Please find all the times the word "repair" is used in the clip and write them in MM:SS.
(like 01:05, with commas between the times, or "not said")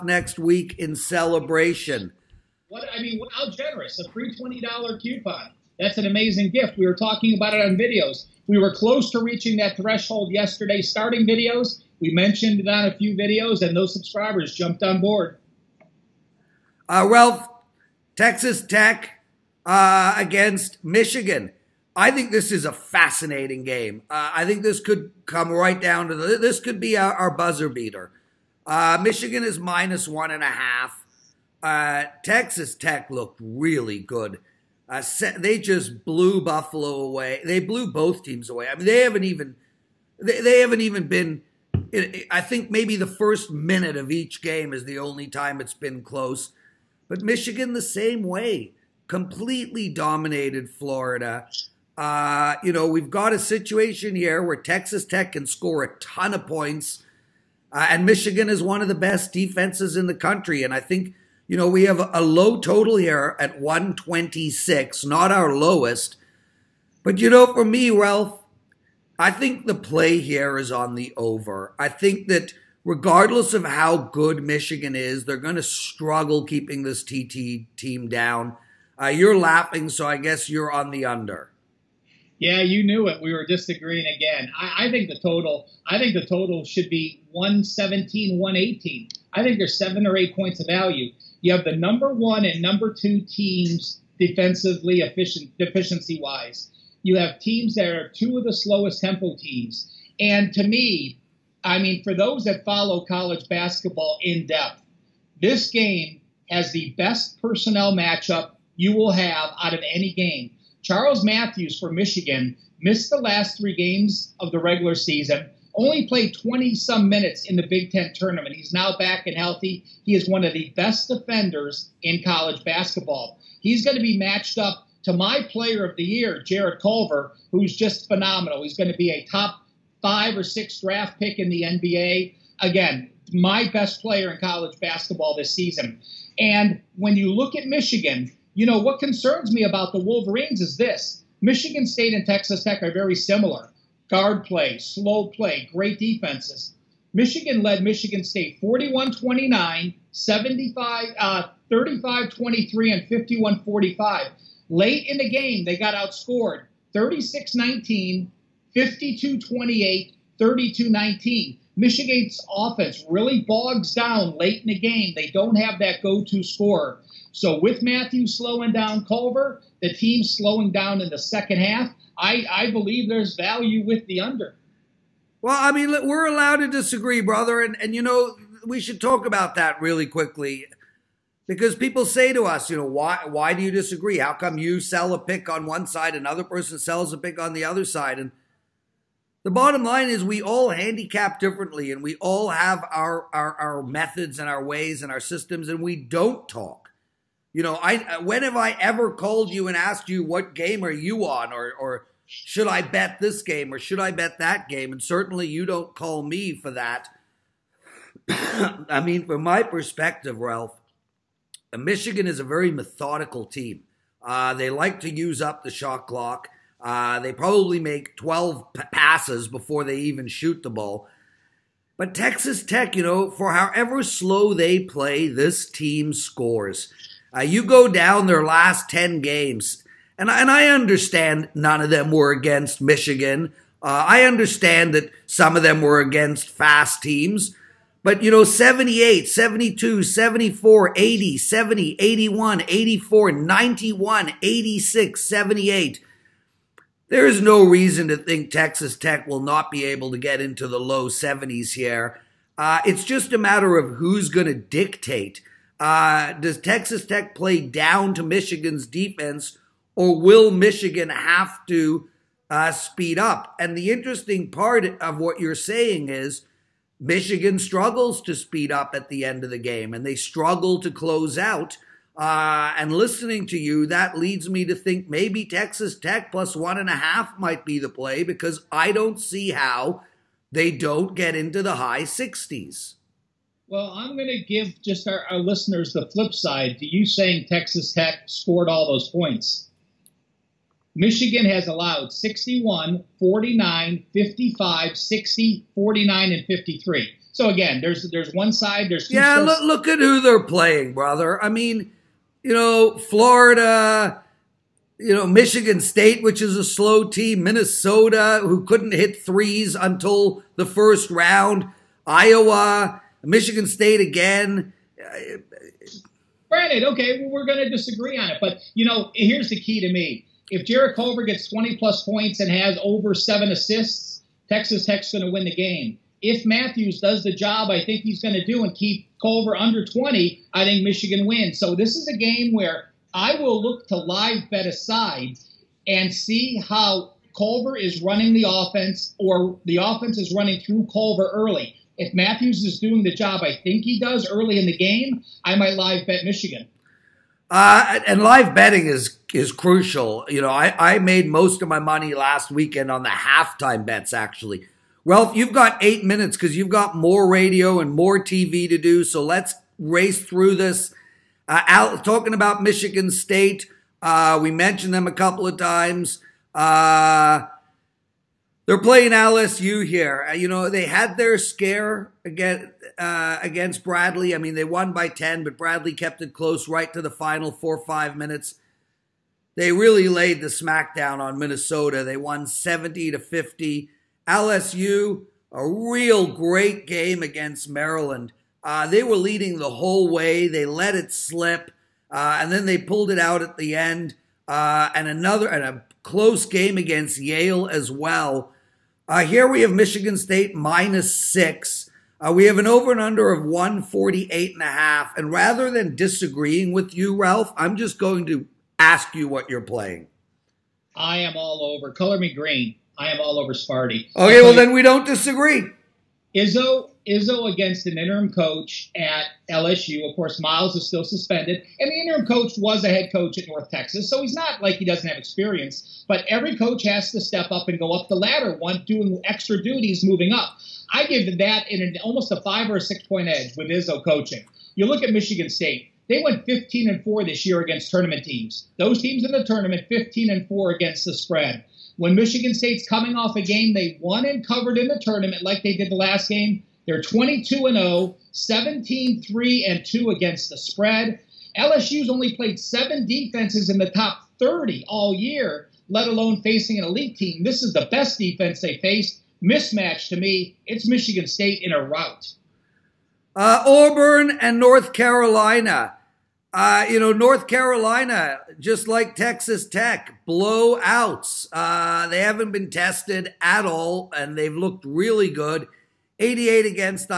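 not said.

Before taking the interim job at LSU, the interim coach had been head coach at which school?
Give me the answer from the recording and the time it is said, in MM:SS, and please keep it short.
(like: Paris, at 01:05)
North Texas, at 07:03.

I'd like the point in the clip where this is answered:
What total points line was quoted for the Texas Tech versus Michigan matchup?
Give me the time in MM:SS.
01:03.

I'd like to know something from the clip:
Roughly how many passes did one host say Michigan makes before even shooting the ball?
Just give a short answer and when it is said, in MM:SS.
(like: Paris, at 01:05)
12, at 03:38.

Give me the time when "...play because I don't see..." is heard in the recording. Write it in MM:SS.
04:37.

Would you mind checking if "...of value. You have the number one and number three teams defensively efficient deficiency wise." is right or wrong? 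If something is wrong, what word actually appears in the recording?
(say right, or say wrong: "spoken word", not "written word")
wrong: "two", not "three".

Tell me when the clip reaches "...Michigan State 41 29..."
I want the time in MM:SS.
02:27.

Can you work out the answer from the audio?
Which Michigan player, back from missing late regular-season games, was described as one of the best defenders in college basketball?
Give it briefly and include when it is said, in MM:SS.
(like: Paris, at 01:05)
Charles Matthews, at 01:50.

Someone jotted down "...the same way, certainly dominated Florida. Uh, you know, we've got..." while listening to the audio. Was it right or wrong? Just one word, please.
wrong.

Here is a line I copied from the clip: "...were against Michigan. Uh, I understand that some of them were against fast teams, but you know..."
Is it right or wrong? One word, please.
right.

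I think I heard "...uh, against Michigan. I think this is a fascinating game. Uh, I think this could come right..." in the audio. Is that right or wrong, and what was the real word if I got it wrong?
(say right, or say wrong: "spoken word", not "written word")
right.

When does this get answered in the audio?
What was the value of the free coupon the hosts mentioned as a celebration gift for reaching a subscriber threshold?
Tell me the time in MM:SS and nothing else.
00:04.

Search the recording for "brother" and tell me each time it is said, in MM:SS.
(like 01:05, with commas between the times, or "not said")
02:57, 05:00.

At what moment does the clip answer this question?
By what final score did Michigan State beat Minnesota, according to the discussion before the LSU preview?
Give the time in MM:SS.
06:22.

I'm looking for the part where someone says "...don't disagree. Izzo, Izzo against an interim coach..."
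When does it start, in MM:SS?
06:54.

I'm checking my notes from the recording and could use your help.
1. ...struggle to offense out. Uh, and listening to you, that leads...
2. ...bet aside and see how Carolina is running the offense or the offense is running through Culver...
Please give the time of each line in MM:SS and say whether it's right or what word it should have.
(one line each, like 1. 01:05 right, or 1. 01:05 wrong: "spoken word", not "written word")
1. 04:30 wrong: "close", not "offense"
2. 05:34 wrong: "Culver", not "Carolina".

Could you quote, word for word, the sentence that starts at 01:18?
Uh, you're laughing, so I guess you're on the under.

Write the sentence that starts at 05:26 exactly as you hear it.
If Matthews does the job I think he's going to do and keep Culver under 20, I think Michigan wins.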